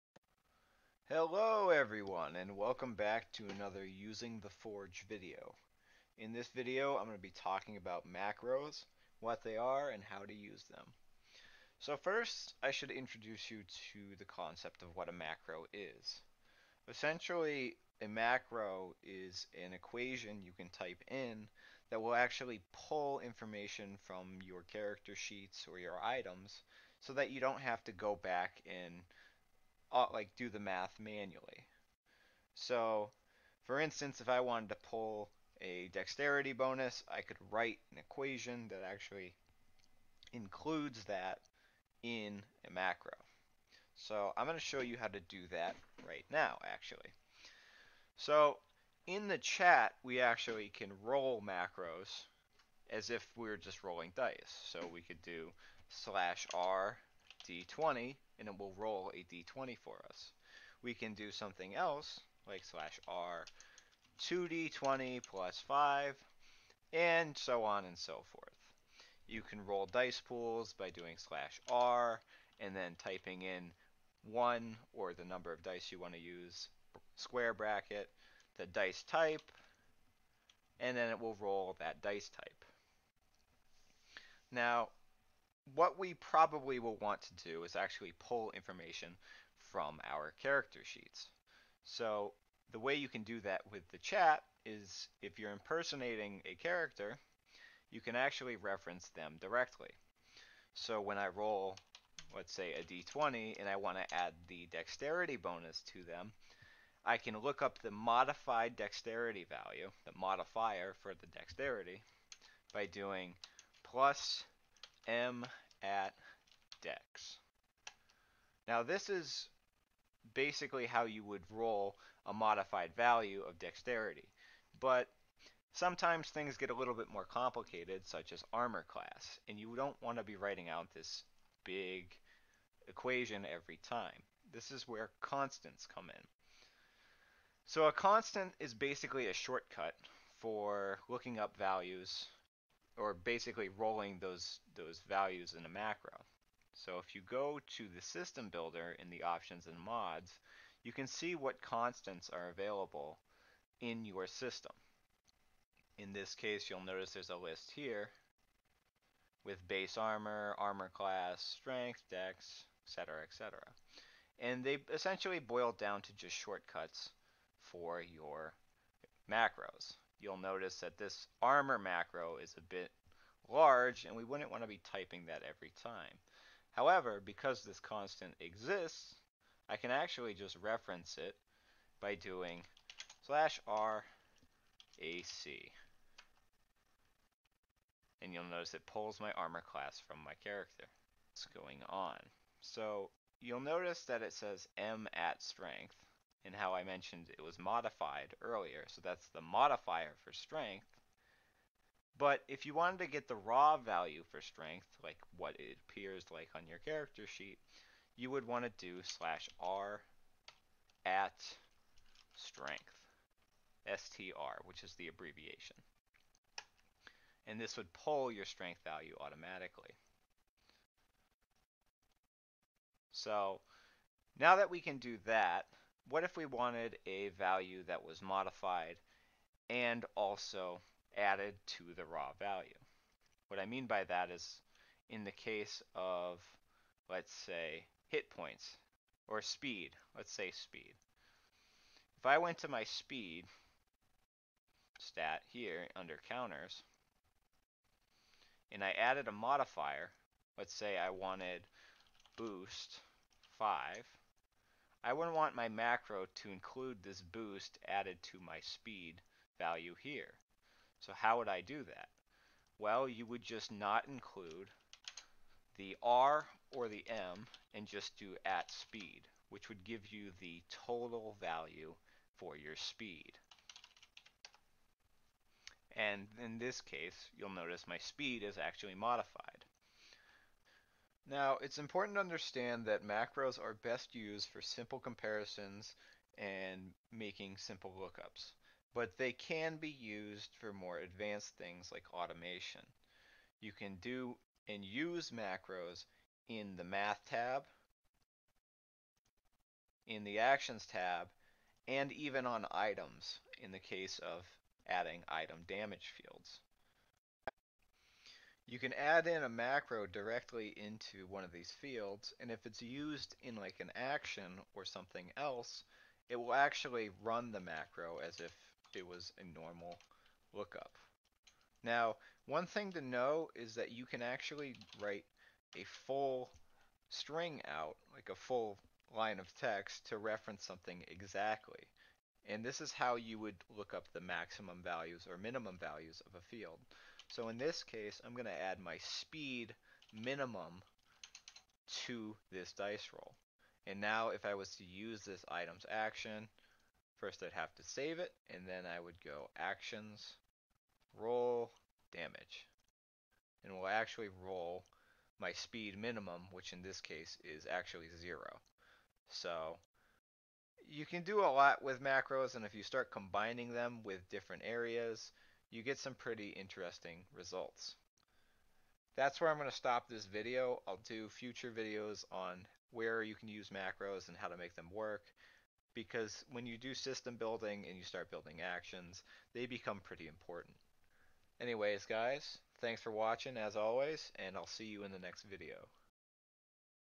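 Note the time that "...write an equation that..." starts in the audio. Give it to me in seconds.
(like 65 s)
37 s.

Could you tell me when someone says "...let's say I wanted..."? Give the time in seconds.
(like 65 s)
250 s.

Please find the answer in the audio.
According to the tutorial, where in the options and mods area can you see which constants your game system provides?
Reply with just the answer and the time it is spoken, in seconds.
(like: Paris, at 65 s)
system builder, at 148 s.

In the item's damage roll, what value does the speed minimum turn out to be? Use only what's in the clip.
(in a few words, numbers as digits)
0.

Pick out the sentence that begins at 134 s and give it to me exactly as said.
This is where constants come in.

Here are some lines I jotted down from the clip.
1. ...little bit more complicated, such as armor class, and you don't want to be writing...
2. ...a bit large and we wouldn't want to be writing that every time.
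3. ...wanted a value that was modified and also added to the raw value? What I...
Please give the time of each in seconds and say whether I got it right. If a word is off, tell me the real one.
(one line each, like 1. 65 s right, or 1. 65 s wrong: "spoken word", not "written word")
1. 126 s right
2. 172 s wrong: "typing", not "writing"
3. 226 s right.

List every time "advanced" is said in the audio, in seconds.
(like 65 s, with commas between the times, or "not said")
290 s.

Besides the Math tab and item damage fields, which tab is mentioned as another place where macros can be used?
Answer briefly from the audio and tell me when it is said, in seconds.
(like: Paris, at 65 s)
Actions tab, at 300 s.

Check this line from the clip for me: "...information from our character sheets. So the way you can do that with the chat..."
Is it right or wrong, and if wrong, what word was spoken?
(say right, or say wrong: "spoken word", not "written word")
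right.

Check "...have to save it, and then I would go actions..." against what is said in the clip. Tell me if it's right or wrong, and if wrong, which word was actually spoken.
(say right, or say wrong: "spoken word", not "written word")
right.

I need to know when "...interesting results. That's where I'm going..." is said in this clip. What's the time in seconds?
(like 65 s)
366 s.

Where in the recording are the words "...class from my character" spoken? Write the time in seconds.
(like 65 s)
189 s.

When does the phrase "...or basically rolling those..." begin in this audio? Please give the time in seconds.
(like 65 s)
142 s.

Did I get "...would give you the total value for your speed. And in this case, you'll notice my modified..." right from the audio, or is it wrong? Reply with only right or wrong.
wrong.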